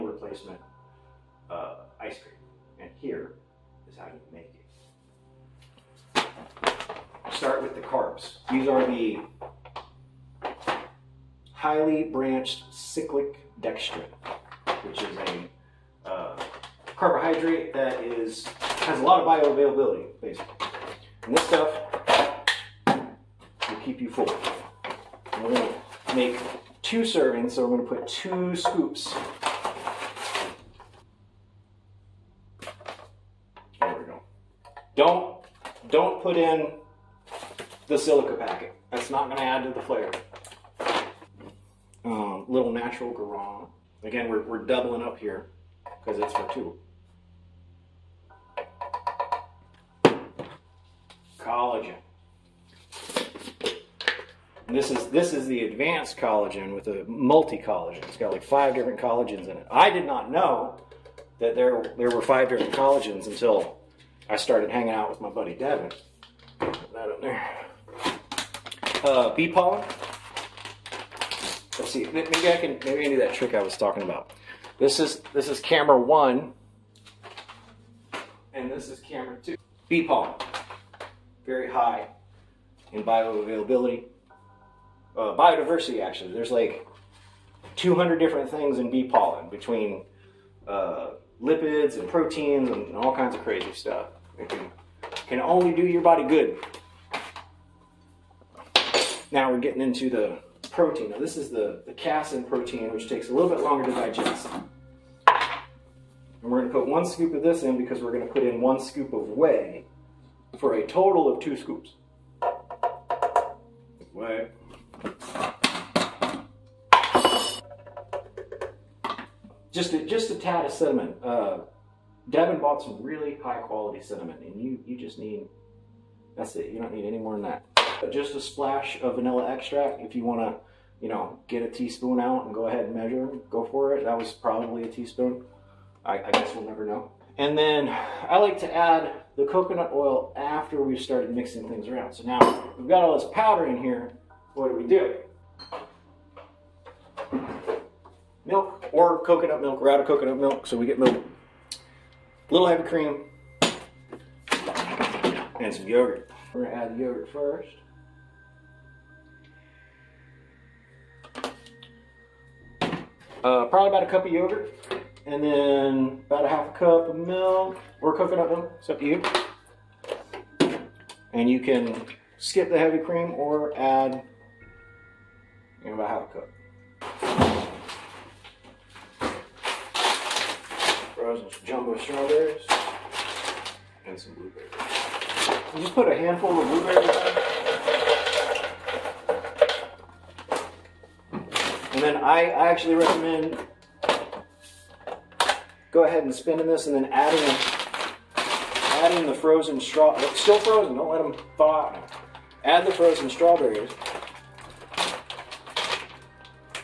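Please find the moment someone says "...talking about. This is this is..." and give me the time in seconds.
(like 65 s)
73 s.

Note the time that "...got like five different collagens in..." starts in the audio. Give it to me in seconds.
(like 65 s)
58 s.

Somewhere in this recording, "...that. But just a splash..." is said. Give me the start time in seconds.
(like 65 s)
127 s.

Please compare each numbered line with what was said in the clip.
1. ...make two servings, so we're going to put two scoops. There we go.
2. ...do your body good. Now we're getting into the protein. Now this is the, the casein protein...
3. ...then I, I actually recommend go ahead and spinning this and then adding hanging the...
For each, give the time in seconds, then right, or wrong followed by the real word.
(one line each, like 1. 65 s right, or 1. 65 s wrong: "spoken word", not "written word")
1. 26 s right
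2. 95 s right
3. 192 s wrong: "adding", not "hanging".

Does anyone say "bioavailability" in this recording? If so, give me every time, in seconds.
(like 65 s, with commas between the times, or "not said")
19 s, 83 s.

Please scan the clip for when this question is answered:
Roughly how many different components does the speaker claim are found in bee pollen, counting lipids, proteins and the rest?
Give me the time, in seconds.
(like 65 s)
87 s.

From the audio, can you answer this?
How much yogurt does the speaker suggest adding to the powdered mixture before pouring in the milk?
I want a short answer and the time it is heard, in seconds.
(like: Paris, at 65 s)
About a cup, at 163 s.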